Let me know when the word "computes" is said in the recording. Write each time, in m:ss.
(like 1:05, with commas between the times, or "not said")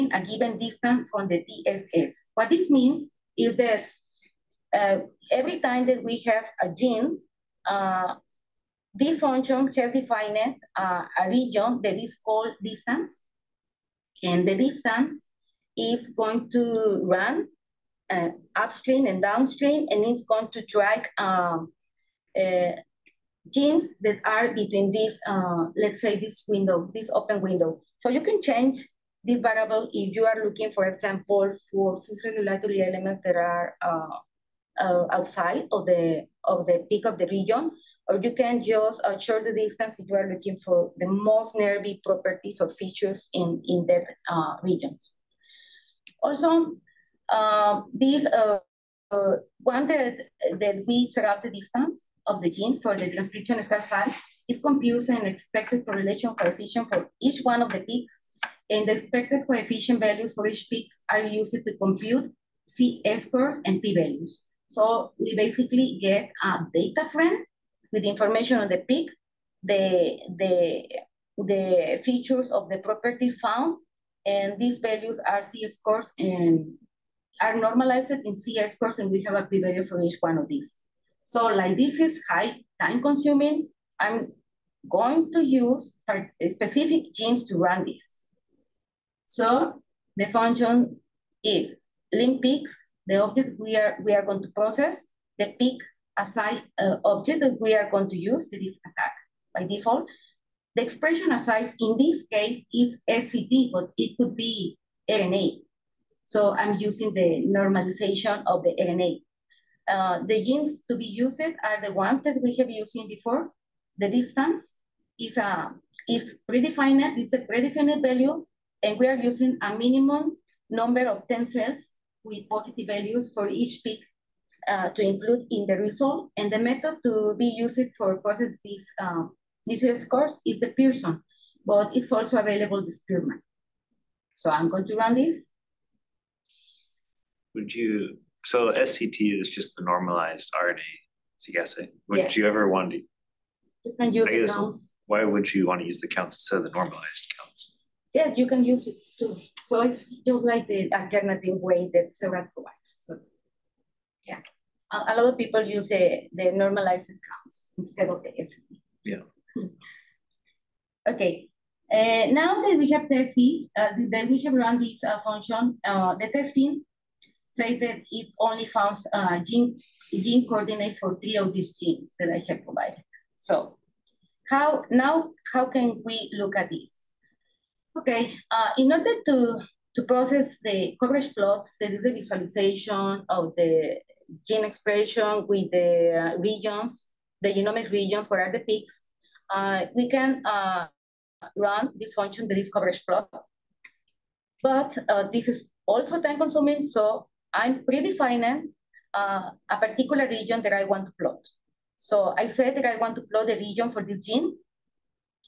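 0:54, 1:01.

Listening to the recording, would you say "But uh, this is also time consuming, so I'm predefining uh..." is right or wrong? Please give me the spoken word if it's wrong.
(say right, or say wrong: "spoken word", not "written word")
right.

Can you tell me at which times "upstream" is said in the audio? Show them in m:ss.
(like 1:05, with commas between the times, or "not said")
0:18.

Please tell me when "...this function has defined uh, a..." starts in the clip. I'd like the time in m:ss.
0:08.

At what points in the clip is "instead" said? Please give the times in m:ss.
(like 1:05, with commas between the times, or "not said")
2:26, 2:37.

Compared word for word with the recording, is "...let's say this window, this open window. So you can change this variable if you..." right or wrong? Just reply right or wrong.
right.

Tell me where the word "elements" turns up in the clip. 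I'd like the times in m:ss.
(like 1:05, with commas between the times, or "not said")
0:32.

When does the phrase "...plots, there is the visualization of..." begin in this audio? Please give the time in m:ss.
3:01.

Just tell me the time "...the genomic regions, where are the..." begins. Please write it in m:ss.
3:07.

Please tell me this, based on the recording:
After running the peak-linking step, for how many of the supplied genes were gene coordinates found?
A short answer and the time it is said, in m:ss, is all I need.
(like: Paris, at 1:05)
3, at 2:51.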